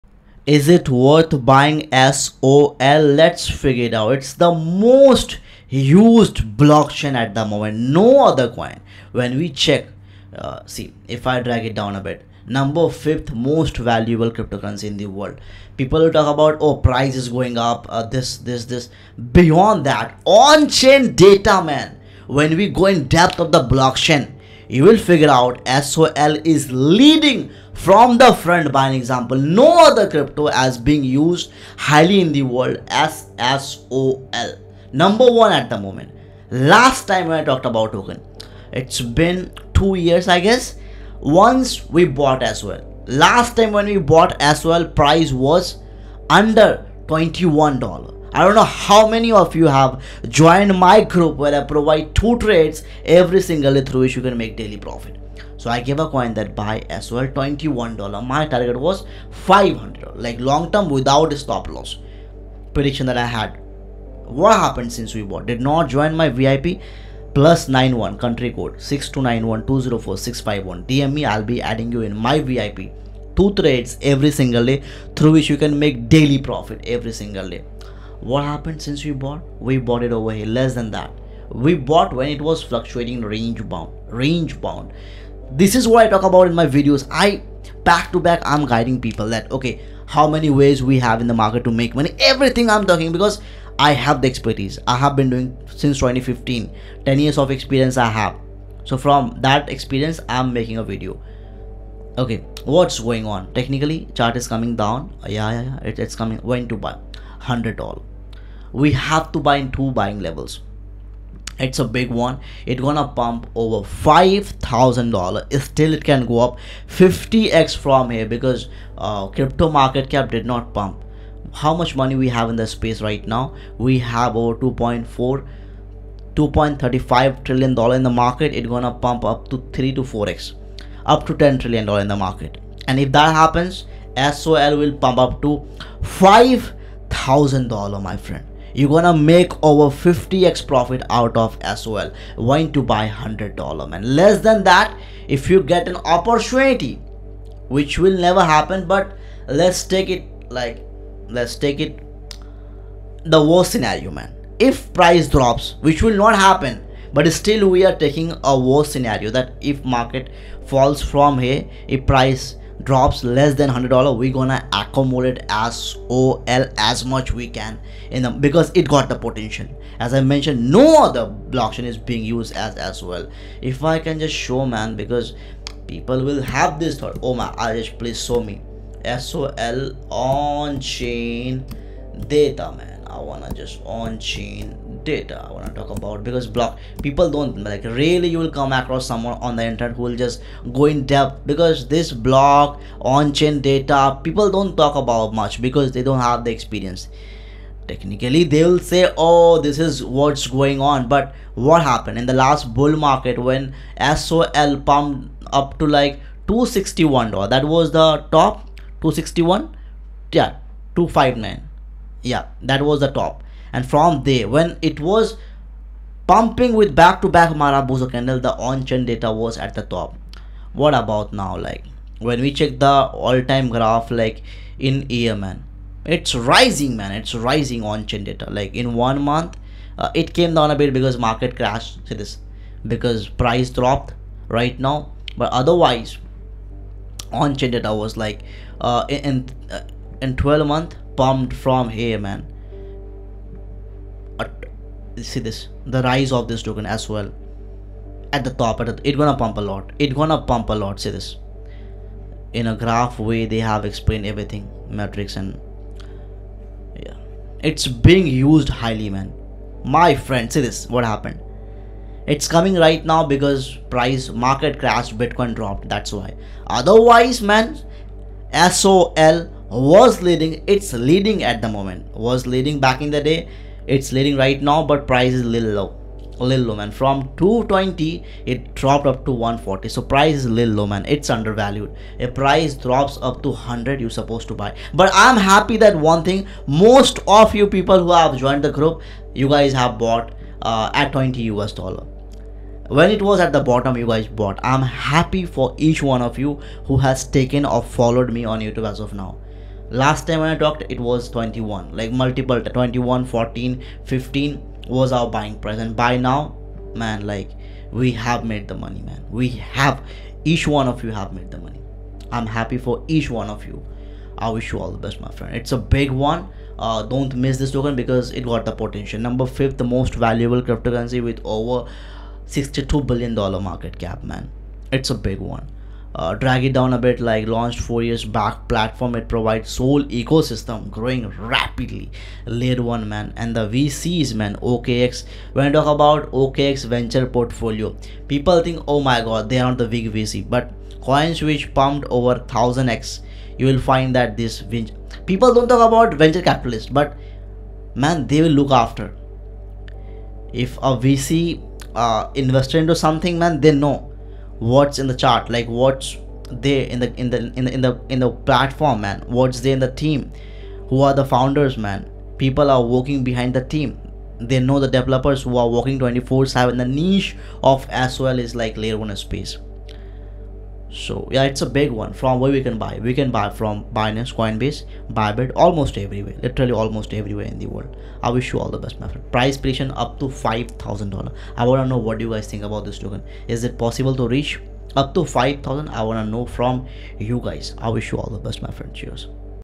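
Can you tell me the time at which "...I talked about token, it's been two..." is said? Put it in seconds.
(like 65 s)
37 s.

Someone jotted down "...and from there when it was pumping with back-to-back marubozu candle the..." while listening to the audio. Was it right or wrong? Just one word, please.
right.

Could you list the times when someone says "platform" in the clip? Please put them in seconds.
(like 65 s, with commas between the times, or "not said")
328 s, 358 s.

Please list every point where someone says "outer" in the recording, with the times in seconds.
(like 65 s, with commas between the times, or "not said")
not said.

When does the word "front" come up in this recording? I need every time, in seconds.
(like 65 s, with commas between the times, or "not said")
28 s.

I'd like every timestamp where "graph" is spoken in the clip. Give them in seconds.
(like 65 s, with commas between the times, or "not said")
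223 s, 252 s.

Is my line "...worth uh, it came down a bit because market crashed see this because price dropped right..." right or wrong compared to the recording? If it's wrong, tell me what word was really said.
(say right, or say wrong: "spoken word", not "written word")
wrong: "month", not "worth".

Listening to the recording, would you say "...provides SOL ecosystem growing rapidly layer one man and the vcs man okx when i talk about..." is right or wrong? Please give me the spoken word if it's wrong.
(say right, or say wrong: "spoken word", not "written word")
right.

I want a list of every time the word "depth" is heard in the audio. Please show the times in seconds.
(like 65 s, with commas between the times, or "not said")
23 s, 191 s.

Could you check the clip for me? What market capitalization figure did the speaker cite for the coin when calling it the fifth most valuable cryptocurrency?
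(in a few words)
62 billion dollars.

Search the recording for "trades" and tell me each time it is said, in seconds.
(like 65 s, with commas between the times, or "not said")
52 s, 73 s.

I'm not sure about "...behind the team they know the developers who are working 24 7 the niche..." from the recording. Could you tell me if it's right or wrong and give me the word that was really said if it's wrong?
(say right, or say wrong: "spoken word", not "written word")
right.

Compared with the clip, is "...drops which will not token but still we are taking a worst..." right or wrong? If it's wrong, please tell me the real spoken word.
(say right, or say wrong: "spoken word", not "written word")
wrong: "happen", not "token".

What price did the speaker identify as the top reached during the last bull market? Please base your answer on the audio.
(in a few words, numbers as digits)
$261.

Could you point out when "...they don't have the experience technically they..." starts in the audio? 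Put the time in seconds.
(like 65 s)
195 s.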